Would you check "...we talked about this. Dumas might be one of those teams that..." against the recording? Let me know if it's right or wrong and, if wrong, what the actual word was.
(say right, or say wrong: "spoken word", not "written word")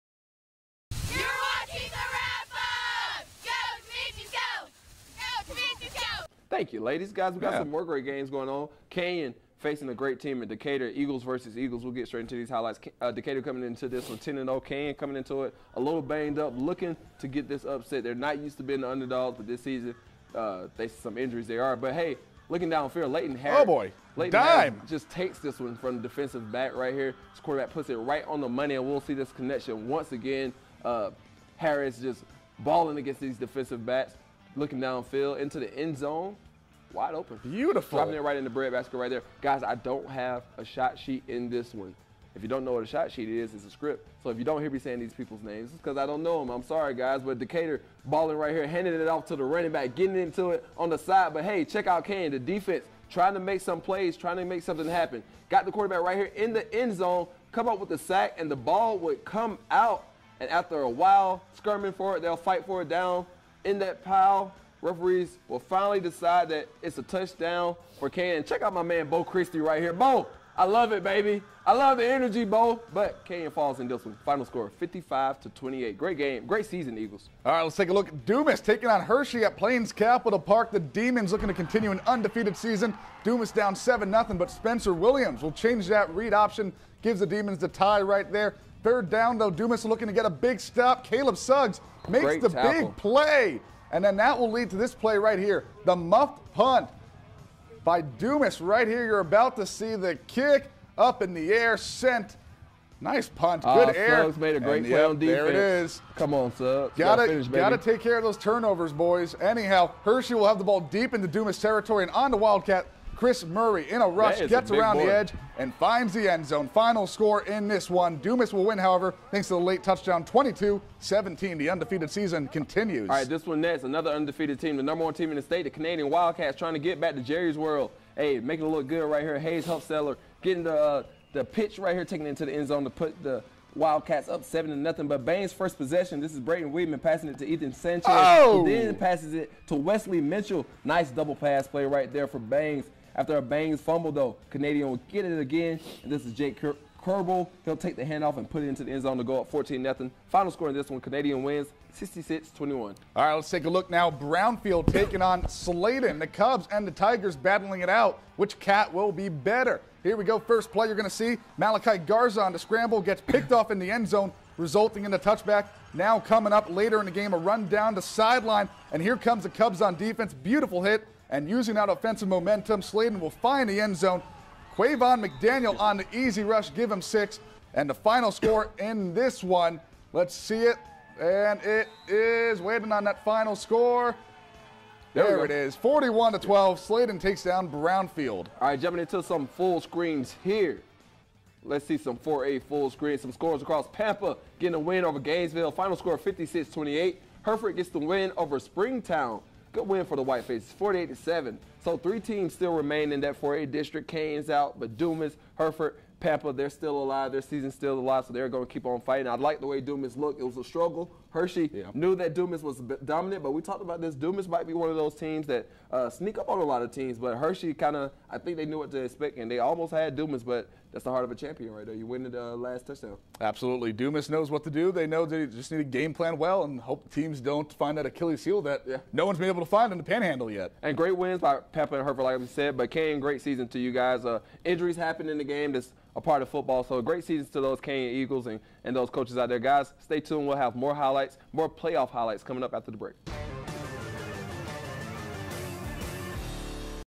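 right.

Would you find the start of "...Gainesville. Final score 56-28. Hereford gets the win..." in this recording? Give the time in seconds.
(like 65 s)
195 s.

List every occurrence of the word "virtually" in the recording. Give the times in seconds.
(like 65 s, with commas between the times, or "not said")
not said.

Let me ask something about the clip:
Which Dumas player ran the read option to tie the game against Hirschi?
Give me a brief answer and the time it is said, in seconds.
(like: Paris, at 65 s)
Spencer Williams, at 84 s.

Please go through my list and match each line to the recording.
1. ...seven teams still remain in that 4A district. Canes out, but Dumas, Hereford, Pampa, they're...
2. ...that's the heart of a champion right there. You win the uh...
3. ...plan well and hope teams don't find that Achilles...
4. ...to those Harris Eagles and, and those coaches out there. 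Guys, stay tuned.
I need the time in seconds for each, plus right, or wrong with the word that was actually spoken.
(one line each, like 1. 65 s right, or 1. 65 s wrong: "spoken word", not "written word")
1. 201 s wrong: "three", not "seven"
2. 220 s right
3. 226 s right
4. 237 s wrong: "Kane", not "Harris".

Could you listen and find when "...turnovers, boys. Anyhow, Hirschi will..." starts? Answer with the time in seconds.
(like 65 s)
108 s.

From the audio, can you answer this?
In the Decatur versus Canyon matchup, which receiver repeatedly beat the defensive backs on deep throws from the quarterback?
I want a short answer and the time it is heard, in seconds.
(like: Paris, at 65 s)
Leighton Harris, at 23 s.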